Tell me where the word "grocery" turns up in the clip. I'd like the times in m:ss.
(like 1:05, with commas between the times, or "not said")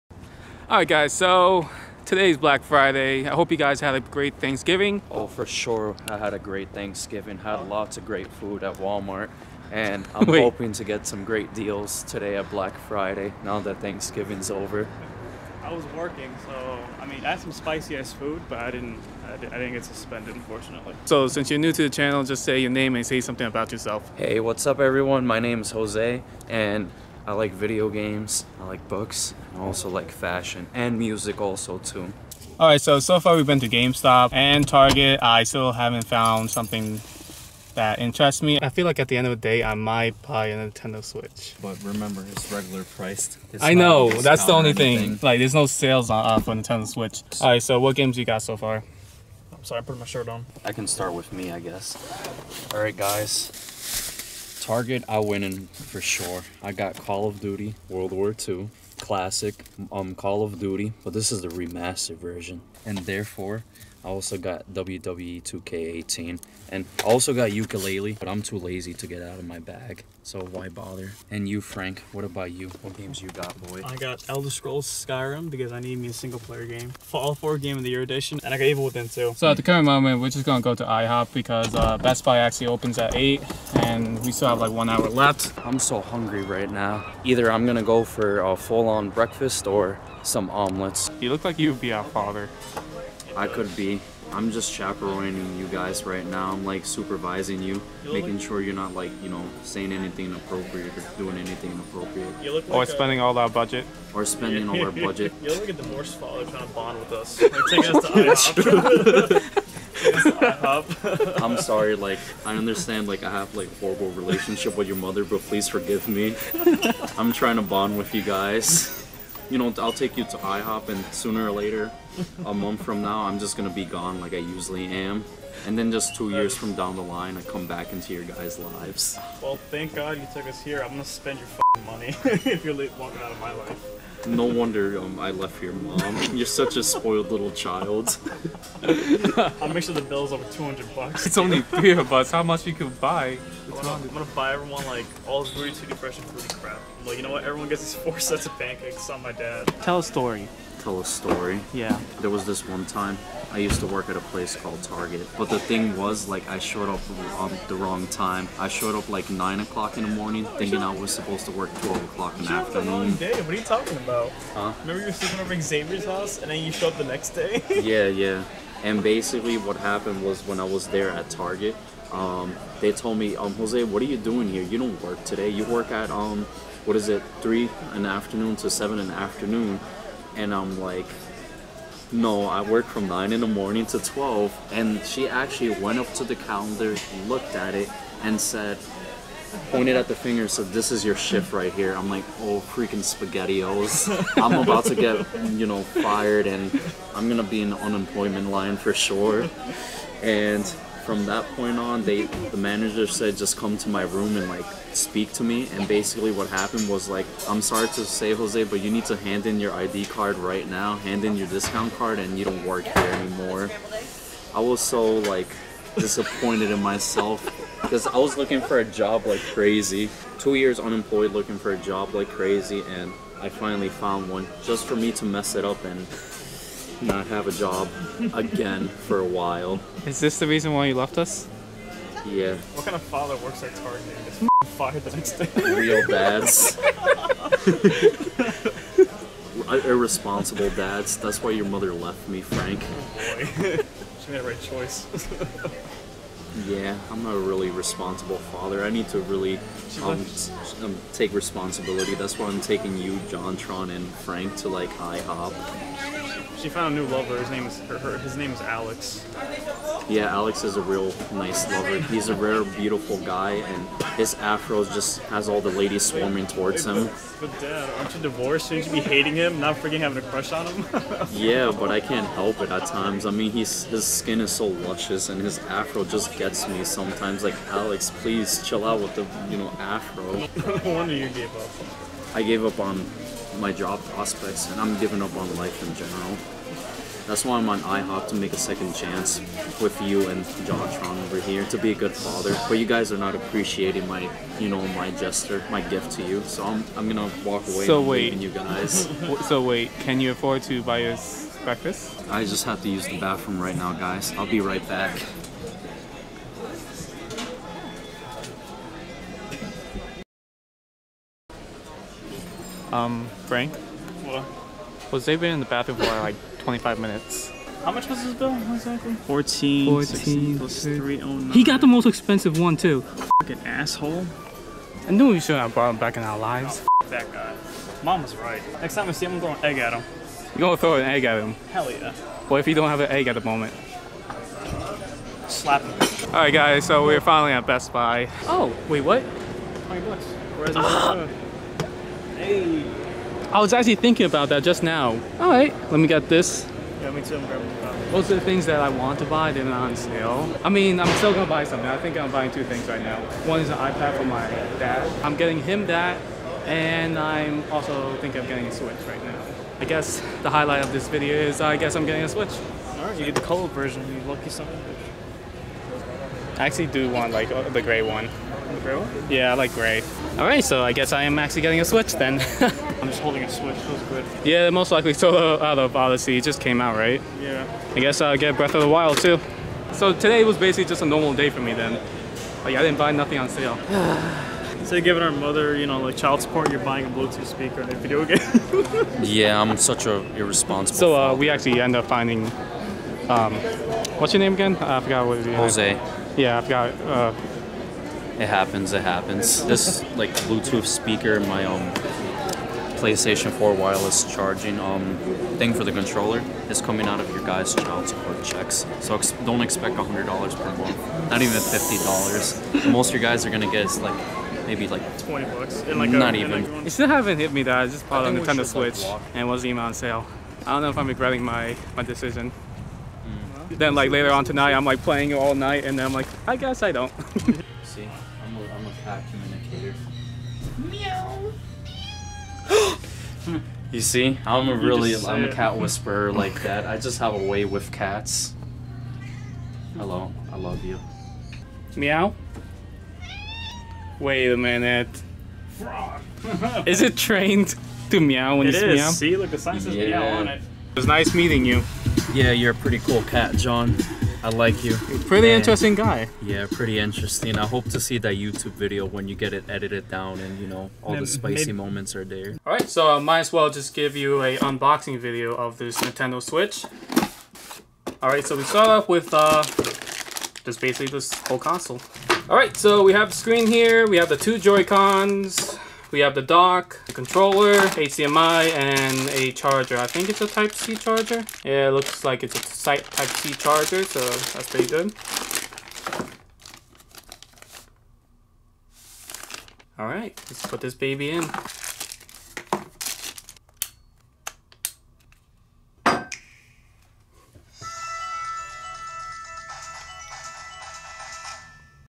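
not said.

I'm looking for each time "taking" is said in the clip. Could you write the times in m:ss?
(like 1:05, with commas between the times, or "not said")
1:47, 4:12.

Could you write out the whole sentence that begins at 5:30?
You're gonna throw an egg at him?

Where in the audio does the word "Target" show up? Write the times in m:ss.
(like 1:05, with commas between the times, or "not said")
0:34, 0:54, 2:34, 2:51, 3:53.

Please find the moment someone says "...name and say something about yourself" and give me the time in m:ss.
0:22.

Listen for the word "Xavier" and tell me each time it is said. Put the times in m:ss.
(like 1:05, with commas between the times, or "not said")
2:45.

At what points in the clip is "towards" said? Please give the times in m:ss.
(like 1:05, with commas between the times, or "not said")
4:26.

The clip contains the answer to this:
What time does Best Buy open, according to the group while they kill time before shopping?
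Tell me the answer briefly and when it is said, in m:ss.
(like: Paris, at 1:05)
8, at 1:23.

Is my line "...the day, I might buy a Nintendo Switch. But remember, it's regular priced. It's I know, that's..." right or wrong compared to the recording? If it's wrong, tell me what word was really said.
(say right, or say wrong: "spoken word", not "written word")
right.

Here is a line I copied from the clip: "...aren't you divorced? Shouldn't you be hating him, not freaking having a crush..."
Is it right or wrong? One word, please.
right.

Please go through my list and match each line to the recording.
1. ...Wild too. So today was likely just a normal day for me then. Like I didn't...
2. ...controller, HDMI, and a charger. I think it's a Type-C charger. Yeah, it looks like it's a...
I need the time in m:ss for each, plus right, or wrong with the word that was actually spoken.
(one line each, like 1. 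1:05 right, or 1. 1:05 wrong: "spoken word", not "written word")
1. 6:18 wrong: "basically", not "likely"
2. 7:57 right.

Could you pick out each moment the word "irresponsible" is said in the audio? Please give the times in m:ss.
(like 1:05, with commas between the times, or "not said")
3:59, 6:30.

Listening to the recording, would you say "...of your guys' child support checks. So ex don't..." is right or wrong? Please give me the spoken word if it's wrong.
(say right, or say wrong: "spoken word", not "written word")
right.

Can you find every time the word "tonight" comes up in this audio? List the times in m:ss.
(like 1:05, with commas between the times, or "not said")
7:04.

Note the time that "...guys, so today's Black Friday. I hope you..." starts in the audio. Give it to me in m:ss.
0:00.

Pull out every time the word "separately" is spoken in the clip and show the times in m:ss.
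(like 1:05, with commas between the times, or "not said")
not said.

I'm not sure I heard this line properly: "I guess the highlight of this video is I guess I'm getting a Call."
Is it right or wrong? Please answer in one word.
wrong.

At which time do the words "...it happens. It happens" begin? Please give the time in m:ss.
6:38.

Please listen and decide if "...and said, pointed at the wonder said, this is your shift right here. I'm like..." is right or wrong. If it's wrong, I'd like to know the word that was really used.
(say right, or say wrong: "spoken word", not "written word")
wrong: "finger", not "wonder".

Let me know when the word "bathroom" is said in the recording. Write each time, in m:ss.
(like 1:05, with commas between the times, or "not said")
5:03, 5:15.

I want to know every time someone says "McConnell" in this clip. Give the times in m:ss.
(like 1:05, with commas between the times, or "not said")
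not said.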